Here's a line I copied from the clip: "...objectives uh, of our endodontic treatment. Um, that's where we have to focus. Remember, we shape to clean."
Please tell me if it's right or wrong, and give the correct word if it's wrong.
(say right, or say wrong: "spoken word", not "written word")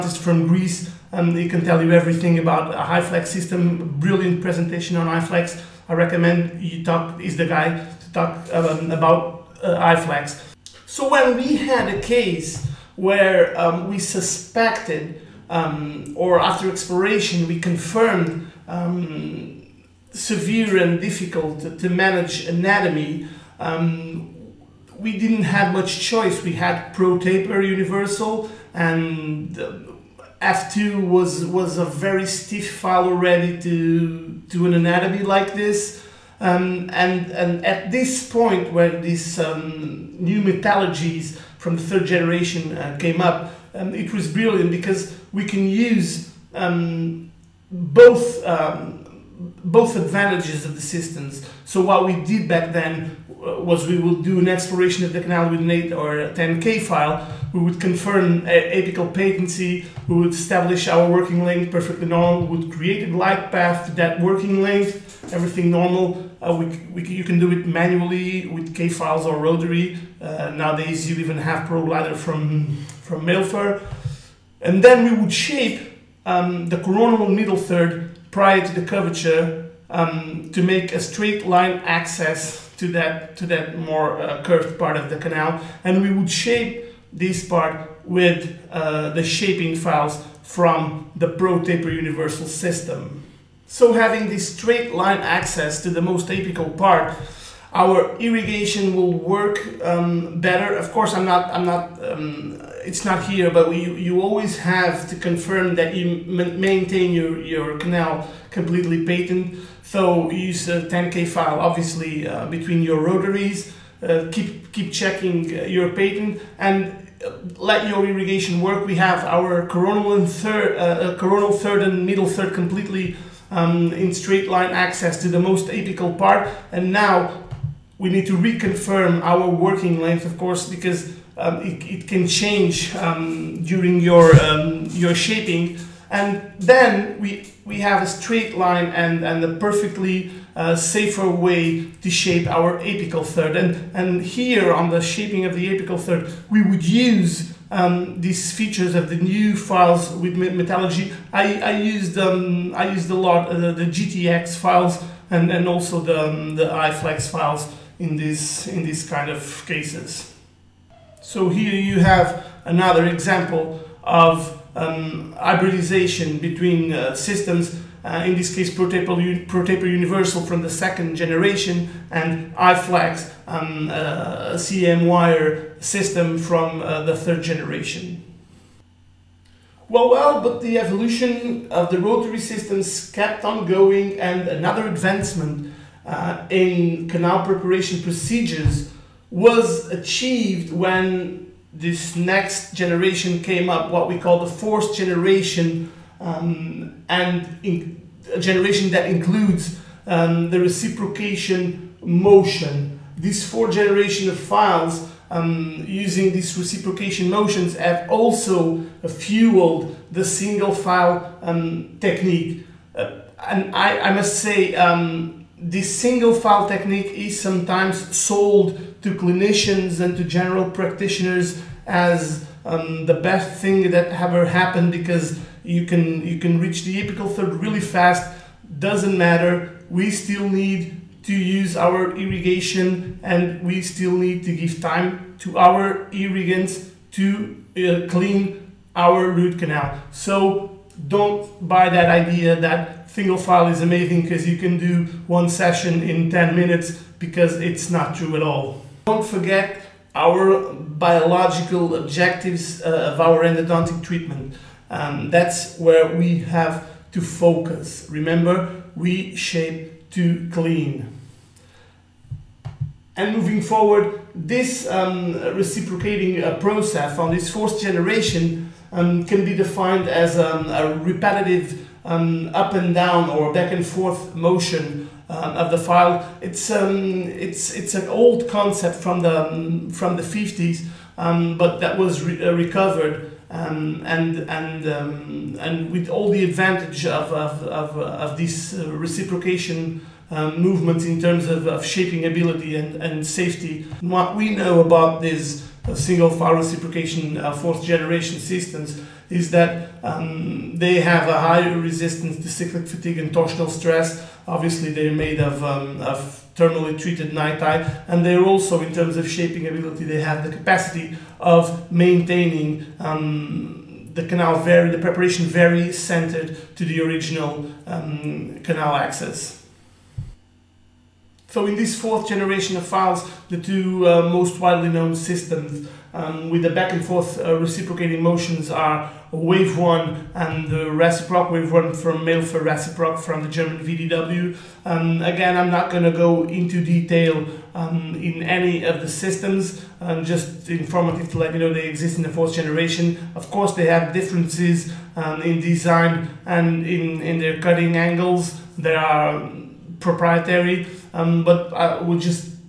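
right.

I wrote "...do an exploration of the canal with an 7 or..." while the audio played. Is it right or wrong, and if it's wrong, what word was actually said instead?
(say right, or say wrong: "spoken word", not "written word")
wrong: "8", not "7".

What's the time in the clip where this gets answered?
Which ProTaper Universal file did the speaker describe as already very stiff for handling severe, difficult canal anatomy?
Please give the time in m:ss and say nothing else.
0:30.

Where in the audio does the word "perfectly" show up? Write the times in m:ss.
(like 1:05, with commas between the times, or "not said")
1:01, 2:19.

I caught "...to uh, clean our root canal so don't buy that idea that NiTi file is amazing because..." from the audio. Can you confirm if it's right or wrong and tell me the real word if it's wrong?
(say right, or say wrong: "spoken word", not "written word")
wrong: "Single", not "NiTi".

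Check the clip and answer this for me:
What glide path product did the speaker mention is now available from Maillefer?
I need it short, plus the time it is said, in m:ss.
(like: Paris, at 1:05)
Pro Glider, at 1:11.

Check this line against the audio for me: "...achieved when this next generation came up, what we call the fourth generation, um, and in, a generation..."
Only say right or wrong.
right.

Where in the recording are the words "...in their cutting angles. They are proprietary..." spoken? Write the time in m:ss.
5:47.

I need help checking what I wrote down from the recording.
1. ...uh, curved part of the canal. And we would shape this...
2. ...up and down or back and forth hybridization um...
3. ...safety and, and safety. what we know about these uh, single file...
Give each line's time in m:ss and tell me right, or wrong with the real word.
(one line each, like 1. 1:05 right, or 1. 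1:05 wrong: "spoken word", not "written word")
1. 1:24 right
2. 4:32 wrong: "motion", not "hybridization"
3. 4:52 wrong: "ability", not "safety".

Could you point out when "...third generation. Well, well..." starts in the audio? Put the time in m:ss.
2:57.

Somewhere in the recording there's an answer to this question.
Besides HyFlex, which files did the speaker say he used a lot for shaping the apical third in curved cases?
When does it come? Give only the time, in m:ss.
2:33.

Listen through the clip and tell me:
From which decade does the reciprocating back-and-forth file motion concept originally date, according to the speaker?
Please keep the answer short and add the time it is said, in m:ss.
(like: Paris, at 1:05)
the 50s, at 4:40.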